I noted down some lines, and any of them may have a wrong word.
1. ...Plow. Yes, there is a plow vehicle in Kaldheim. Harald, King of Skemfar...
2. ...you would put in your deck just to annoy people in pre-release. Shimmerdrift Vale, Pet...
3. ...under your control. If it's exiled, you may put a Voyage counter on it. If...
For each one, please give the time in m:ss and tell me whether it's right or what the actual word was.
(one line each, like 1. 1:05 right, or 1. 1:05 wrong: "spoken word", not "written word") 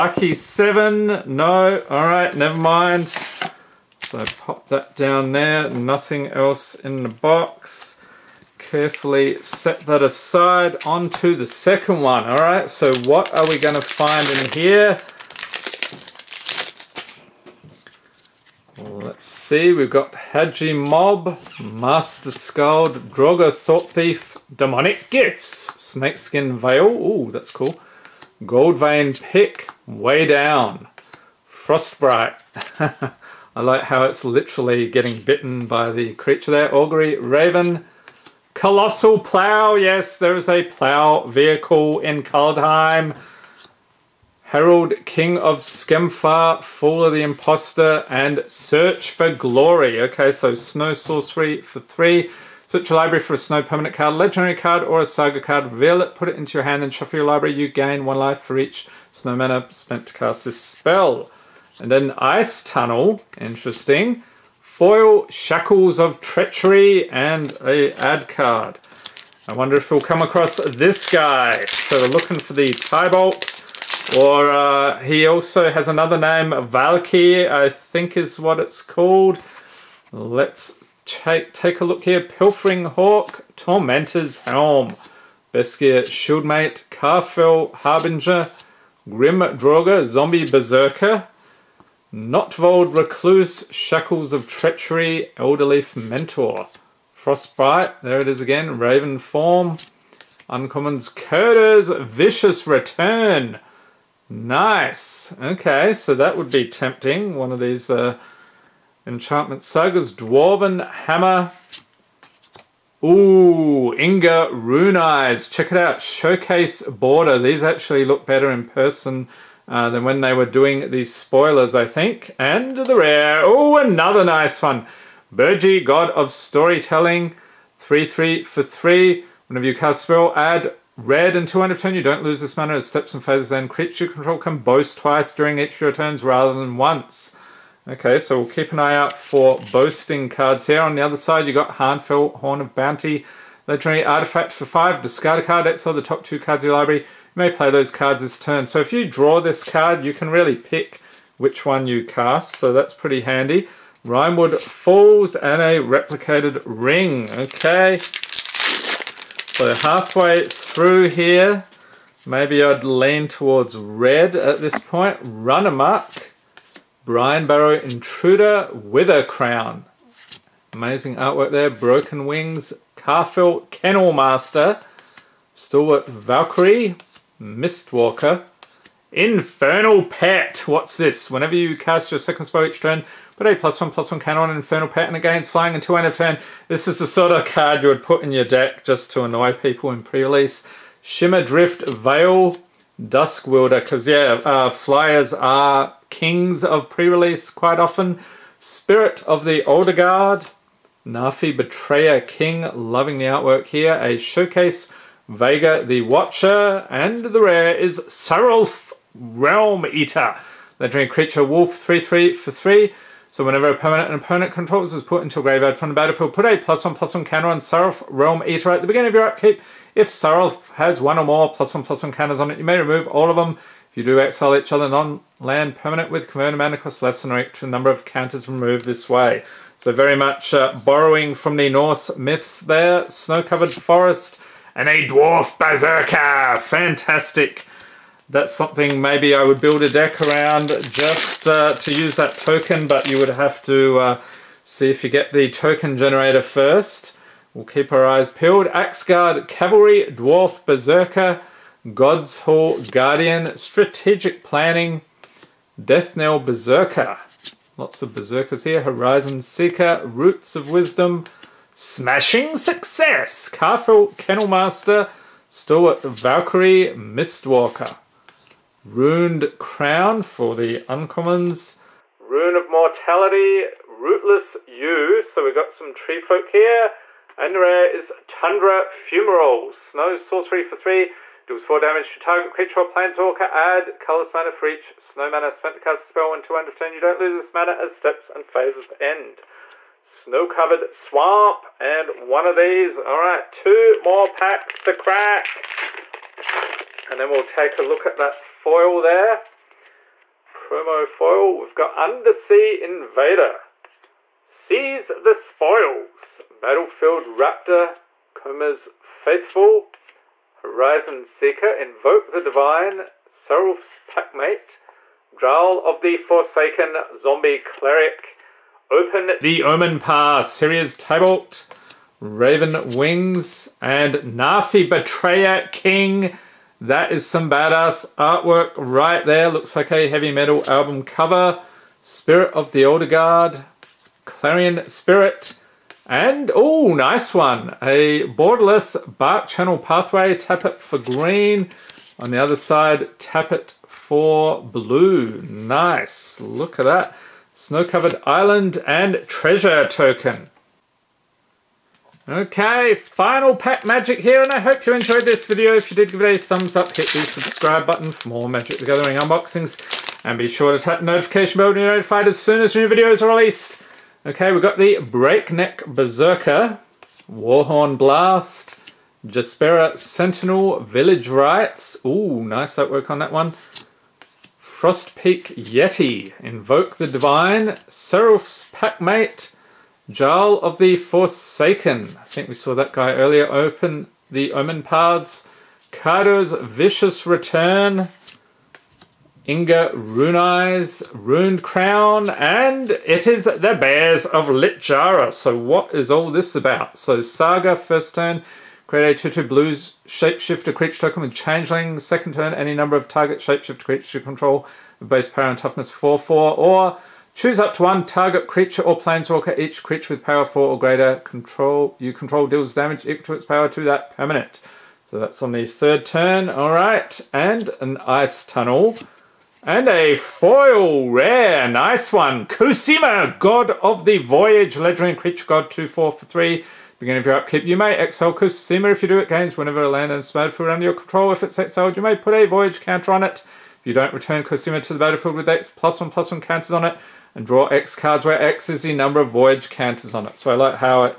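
1. 0:39 right
2. 3:07 wrong: "Dusk", not "Pet"
3. 7:10 right.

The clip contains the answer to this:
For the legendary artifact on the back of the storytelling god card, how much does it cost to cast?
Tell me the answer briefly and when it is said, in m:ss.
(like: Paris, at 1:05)
5, at 2:24.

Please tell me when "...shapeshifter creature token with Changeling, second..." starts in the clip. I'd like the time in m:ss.
6:40.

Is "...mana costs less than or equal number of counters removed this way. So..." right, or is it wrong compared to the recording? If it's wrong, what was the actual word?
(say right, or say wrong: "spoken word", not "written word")
right.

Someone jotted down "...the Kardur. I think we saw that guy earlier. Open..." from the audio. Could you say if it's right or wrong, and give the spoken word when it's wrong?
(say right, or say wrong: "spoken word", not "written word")
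wrong: "Forsaken", not "Kardur".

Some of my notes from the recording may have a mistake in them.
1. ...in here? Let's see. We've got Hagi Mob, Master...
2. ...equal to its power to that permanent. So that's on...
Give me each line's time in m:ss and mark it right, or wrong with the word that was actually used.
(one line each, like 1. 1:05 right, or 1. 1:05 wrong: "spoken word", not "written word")
1. 0:14 right
2. 6:53 right.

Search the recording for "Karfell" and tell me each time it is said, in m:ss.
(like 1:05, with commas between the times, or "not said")
1:26, 2:52, 4:23.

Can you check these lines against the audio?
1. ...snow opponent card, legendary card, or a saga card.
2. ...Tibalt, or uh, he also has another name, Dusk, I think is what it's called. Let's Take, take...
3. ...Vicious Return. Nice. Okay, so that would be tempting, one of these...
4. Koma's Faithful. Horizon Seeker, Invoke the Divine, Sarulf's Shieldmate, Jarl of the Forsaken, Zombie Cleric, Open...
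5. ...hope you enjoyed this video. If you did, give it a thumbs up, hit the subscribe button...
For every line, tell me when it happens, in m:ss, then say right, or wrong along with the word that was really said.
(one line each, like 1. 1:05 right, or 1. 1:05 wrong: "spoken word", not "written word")
1. 0:53 wrong: "permanent", not "opponent"
2. 1:12 wrong: "Valki", not "Dusk"
3. 1:42 right
4. 5:08 wrong: "Packmate", not "Shieldmate"
5. 5:54 right.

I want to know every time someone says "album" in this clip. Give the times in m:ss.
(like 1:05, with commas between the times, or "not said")
5:30.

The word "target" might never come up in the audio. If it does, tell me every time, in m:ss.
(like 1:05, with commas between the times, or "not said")
4:42, 6:43, 6:48.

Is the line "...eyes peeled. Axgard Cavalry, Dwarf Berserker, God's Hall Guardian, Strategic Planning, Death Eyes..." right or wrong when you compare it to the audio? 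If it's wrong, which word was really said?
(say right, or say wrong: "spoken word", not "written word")
wrong: "Knell", not "Eyes".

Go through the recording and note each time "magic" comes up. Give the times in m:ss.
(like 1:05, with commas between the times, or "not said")
5:53, 5:58.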